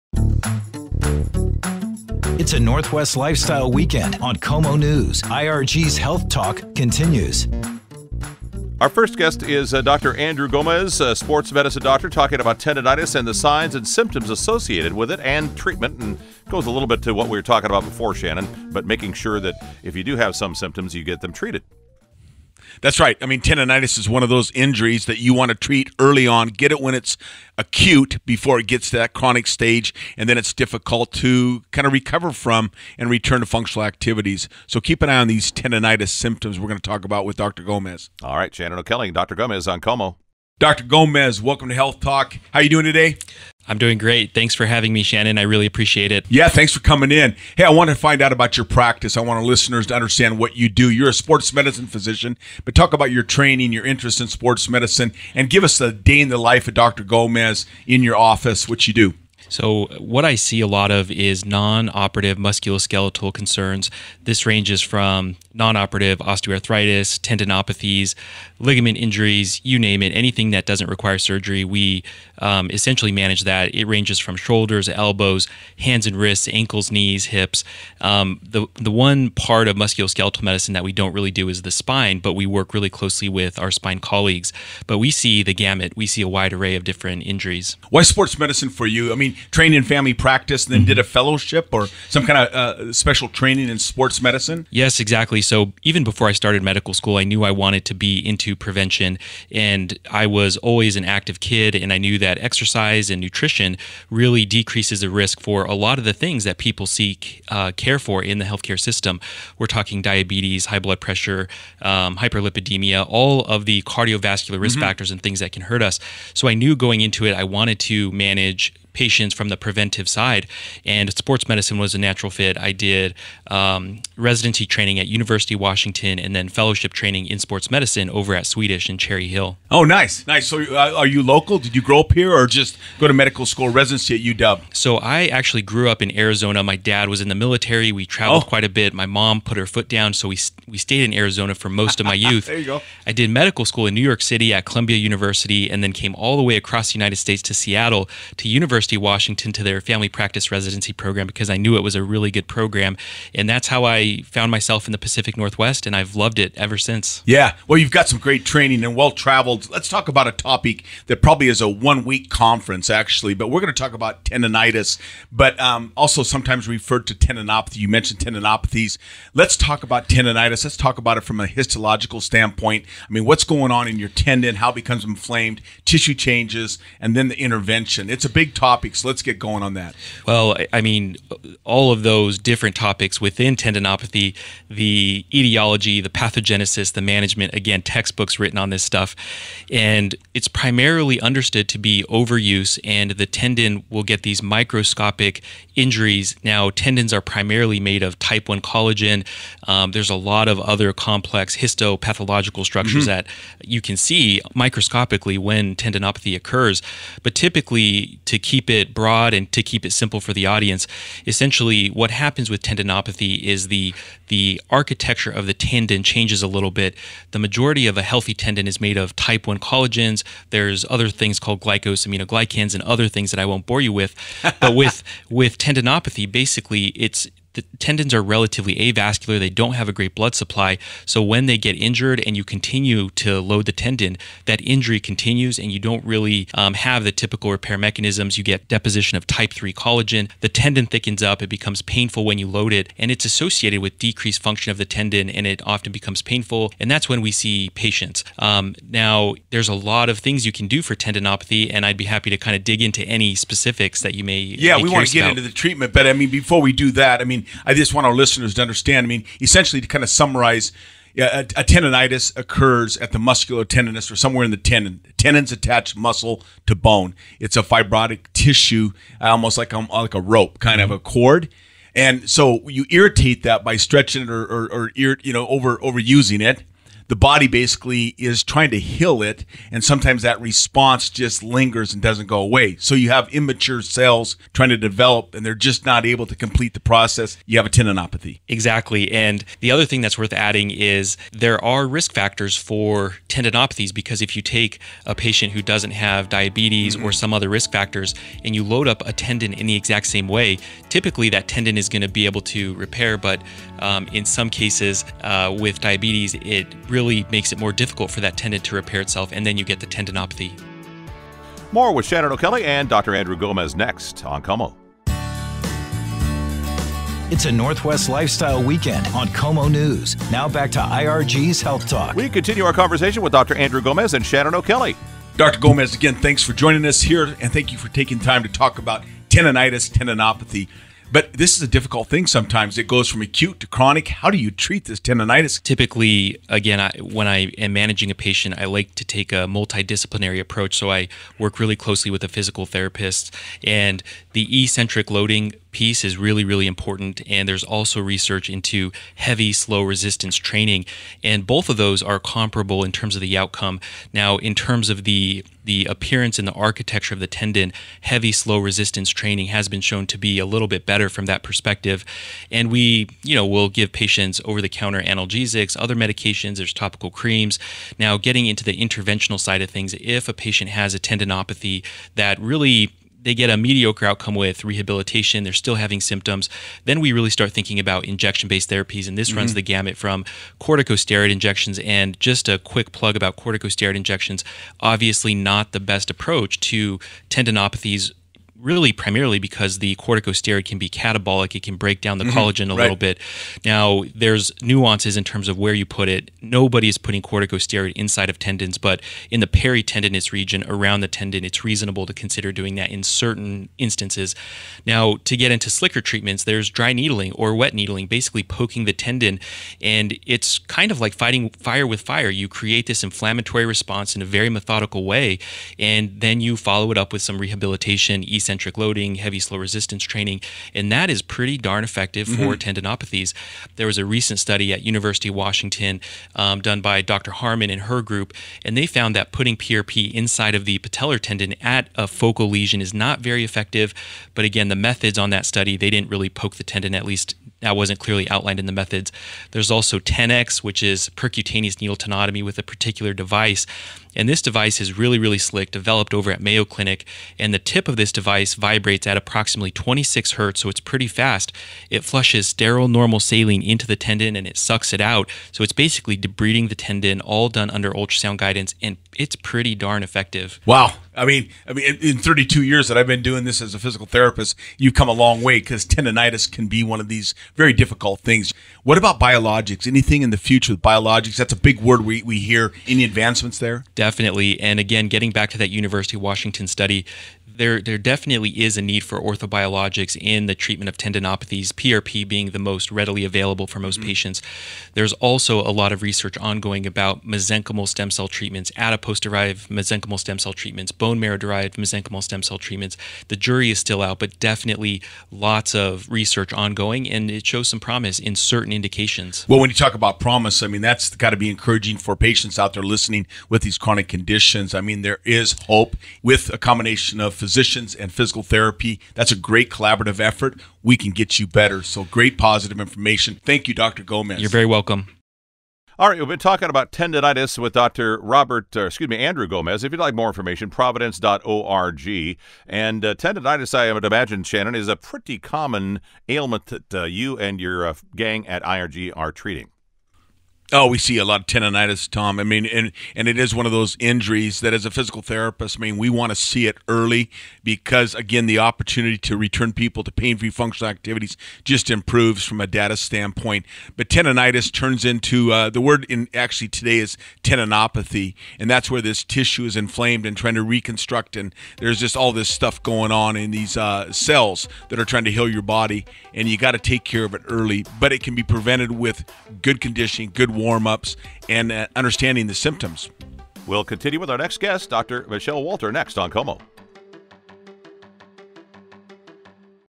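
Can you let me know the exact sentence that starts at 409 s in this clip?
And it's kind of like fighting fire with fire.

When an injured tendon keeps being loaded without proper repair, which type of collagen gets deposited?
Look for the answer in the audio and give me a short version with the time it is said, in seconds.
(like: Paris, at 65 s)
Type 3, at 239 s.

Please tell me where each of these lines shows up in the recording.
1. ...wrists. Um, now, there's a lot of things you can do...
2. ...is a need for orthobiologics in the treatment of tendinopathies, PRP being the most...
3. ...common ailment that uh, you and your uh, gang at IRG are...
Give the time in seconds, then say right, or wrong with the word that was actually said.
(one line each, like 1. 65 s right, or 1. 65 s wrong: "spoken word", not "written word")
1. 247 s wrong: "patients", not "wrists"
2. 478 s right
3. 525 s right.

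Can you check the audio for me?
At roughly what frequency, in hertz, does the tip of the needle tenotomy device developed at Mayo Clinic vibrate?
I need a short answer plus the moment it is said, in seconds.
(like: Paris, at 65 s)
26, at 449 s.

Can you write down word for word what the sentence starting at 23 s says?
I mean, tendonitis is one of those injuries that you want to treat early on.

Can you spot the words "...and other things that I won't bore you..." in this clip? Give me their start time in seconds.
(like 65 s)
222 s.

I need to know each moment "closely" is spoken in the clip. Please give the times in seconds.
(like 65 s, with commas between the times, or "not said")
82 s, 341 s.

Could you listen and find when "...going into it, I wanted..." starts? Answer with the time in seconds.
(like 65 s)
116 s.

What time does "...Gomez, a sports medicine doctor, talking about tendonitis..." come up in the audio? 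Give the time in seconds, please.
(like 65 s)
10 s.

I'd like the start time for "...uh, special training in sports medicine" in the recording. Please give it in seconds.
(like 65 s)
92 s.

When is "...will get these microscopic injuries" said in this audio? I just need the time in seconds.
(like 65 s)
193 s.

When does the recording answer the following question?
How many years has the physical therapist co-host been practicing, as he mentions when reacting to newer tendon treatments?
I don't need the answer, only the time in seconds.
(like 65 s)
462 s.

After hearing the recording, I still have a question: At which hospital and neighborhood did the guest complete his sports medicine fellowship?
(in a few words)
Swedish in Cherry Hill.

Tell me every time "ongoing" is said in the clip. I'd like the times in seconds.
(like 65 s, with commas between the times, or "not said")
486 s, 496 s.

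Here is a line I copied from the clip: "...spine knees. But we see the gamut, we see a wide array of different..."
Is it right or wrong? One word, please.
wrong.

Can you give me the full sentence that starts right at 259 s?
I mean, essentially to kind of summarize, a, a tendonitis occurs at the muscular tendinous or somewhere in the tendon.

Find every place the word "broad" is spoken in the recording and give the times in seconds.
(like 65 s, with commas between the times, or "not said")
208 s.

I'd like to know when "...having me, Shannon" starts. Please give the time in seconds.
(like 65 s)
44 s.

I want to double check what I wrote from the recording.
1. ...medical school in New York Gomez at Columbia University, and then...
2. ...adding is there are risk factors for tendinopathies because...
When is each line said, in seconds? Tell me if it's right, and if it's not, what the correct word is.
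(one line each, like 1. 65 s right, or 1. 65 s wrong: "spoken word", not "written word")
1. 143 s wrong: "City", not "Gomez"
2. 290 s right.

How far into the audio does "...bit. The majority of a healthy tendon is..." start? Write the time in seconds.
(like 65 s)
216 s.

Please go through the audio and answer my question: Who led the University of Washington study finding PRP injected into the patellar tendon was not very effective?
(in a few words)
Dr. Harmon.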